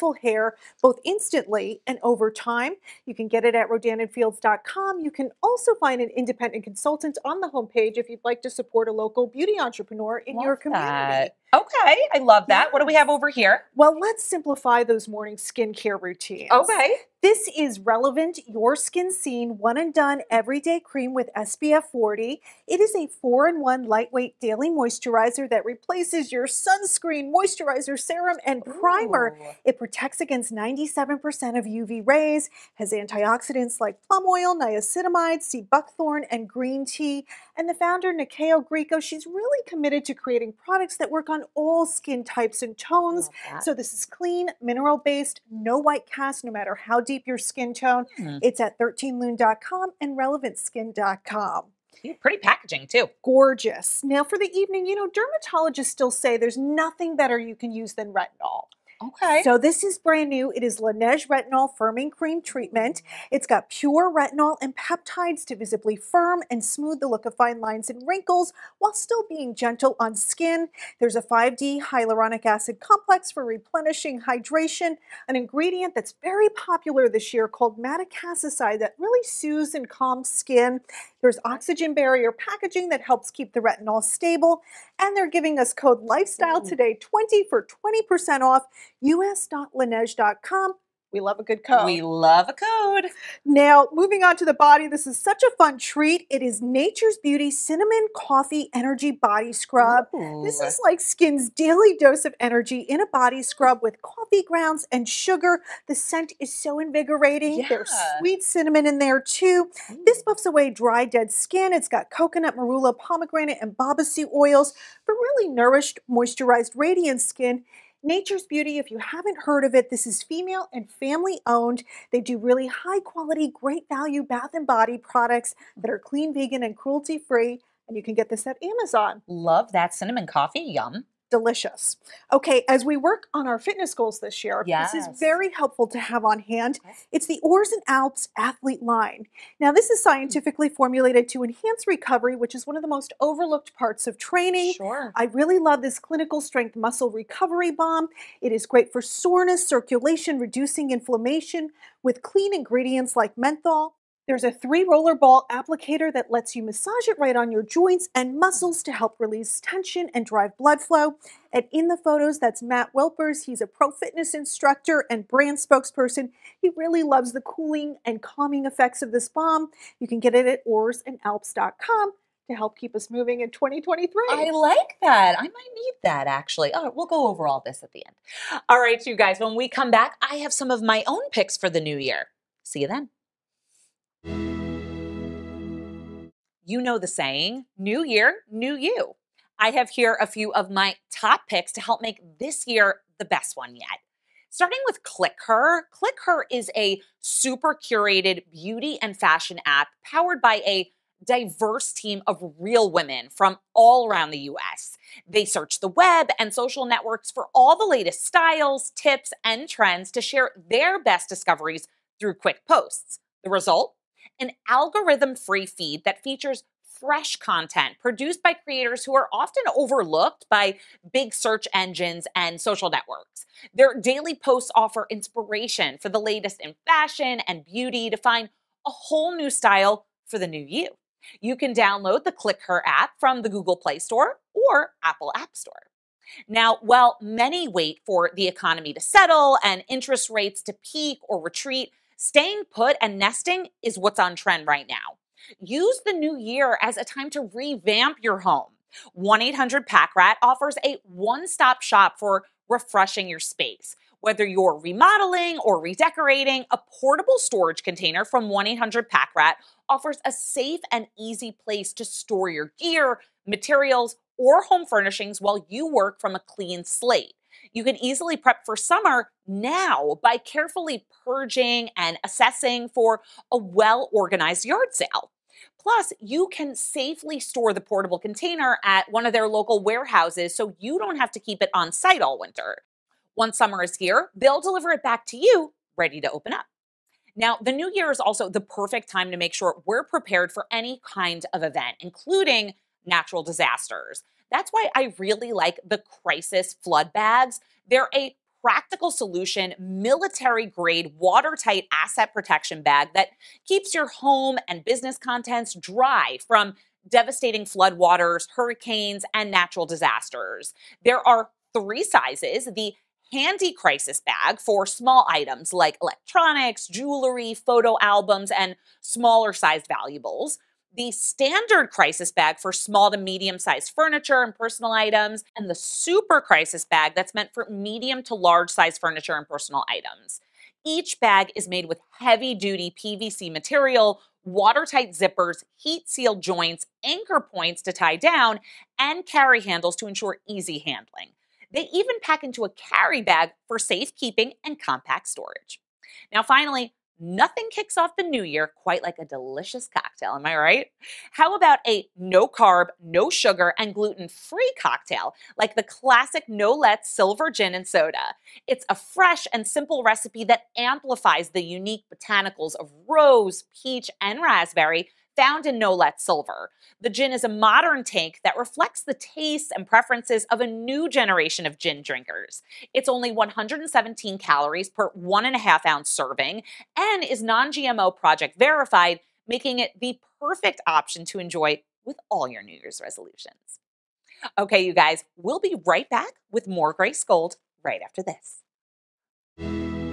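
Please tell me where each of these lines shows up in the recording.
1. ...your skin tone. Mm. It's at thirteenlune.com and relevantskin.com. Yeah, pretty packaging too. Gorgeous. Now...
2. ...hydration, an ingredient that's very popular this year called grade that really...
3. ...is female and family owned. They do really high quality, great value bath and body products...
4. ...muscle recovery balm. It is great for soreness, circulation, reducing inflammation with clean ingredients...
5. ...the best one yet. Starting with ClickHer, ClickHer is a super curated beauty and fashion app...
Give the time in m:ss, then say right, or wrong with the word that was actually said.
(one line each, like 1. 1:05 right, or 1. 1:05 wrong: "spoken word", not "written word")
1. 0:47 right
2. 1:14 wrong: "madecassoside", not "grade"
3. 2:00 right
4. 2:26 right
5. 3:13 right.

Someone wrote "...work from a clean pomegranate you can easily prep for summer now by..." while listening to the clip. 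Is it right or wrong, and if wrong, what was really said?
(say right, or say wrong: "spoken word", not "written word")
wrong: "slate", not "pomegranate".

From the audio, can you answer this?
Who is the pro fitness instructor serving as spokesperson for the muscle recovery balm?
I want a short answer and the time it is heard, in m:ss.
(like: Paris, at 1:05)
Matt Welpers, at 2:42.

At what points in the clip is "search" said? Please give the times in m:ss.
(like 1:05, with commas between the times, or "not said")
3:25, 3:41.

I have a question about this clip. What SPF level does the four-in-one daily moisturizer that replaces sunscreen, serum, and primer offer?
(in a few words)
SPF 40.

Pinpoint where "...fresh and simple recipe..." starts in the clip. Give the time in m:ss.
5:58.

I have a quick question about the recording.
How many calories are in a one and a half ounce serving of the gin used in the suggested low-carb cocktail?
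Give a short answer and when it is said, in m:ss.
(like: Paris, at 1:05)
117, at 6:13.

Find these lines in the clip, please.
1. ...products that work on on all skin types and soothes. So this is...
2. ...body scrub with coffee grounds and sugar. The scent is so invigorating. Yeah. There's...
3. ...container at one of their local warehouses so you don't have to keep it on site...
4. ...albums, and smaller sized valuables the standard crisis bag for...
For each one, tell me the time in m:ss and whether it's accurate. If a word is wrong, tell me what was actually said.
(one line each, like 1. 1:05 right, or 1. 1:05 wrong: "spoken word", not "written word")
1. 0:40 wrong: "tones", not "soothes"
2. 1:43 right
3. 4:38 right
4. 5:18 right.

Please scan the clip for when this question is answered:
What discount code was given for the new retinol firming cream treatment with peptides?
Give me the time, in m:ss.
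1:26.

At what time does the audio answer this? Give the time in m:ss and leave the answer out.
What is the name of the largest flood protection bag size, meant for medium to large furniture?
5:25.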